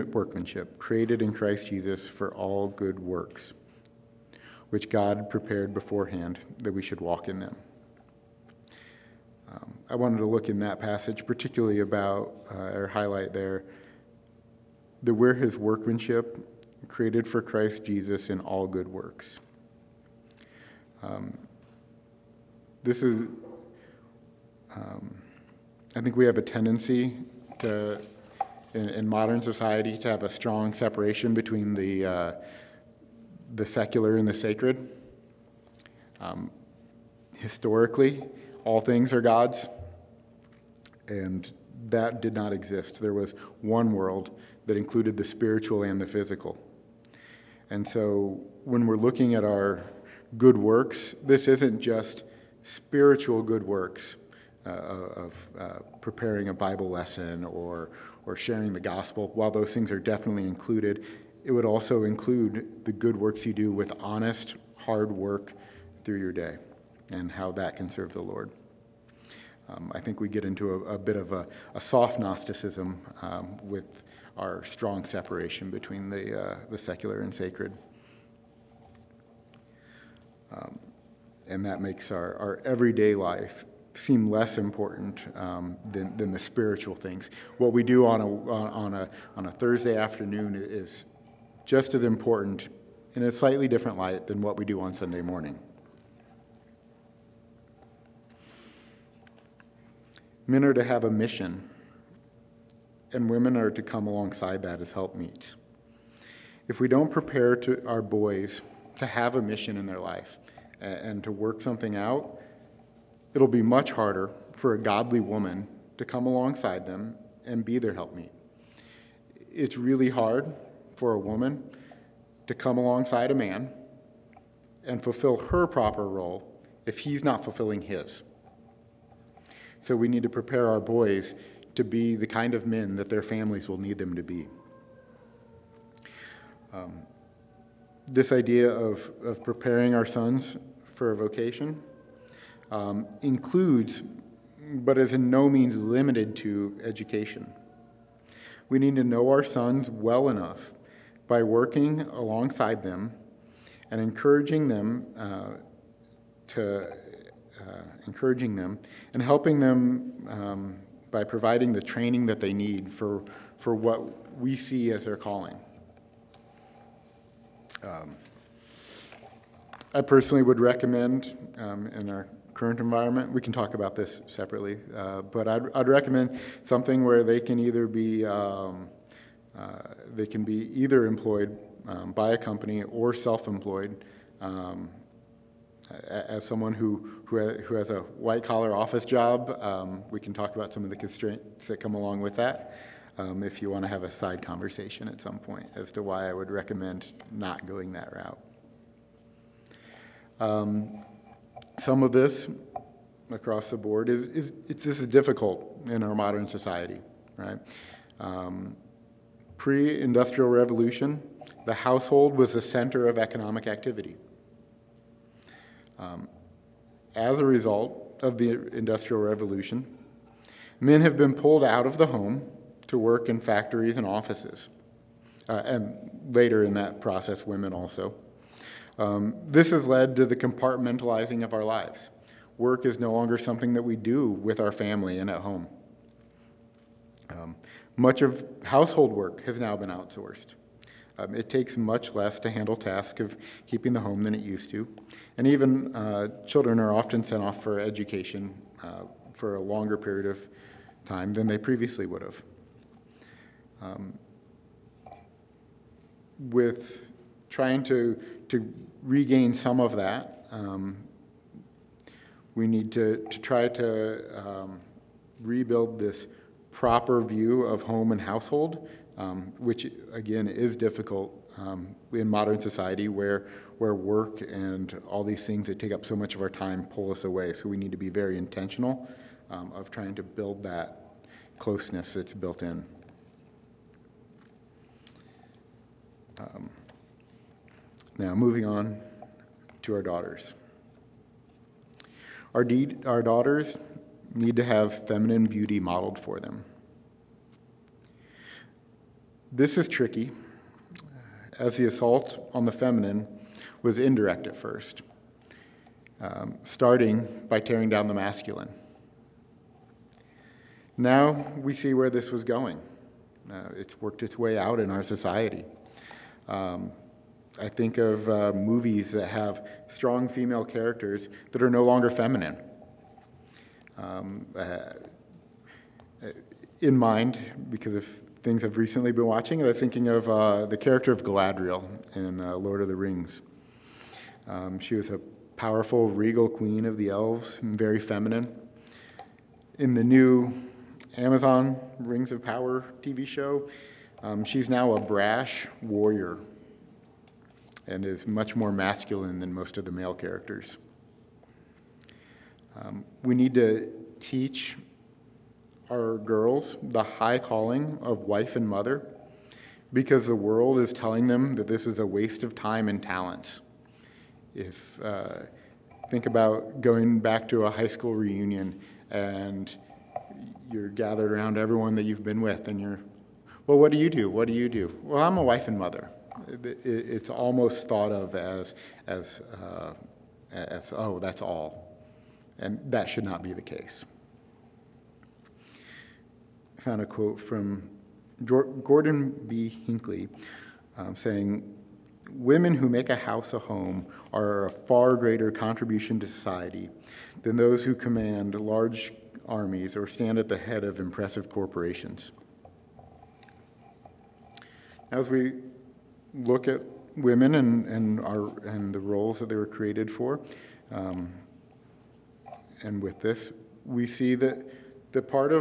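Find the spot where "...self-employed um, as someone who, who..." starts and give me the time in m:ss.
3:03.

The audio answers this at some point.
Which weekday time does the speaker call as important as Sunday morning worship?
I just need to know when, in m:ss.
1:29.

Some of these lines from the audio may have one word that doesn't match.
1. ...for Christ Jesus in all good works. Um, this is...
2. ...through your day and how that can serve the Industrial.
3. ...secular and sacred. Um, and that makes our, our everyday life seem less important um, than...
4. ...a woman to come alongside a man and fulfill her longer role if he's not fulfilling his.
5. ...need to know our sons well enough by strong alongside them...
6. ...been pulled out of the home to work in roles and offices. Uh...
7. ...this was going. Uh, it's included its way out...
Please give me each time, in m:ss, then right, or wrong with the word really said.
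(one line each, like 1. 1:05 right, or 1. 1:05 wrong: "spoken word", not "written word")
1. 0:17 right
2. 1:06 wrong: "Lord", not "Industrial"
3. 1:16 right
4. 2:01 wrong: "proper", not "longer"
5. 2:28 wrong: "working", not "strong"
6. 3:41 wrong: "factories", not "roles"
7. 5:12 wrong: "worked", not "included".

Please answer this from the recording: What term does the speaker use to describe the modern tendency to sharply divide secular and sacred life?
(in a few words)
soft Gnosticism.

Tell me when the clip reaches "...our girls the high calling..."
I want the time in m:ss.
5:55.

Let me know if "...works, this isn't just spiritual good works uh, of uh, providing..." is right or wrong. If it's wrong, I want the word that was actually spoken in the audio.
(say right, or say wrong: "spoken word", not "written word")
wrong: "preparing", not "providing".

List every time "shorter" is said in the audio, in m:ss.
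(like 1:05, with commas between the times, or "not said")
not said.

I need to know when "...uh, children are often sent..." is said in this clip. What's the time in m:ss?
4:05.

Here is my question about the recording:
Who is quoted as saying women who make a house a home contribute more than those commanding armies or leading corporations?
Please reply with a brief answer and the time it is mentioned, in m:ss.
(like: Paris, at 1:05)
Gordon B. Hinckley, at 6:28.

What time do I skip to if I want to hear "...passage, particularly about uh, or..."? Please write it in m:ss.
0:10.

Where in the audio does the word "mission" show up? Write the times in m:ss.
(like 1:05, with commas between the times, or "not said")
1:41, 1:49.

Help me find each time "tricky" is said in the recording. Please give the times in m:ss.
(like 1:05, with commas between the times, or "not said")
4:59.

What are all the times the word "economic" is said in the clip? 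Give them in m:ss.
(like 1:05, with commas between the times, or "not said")
3:33.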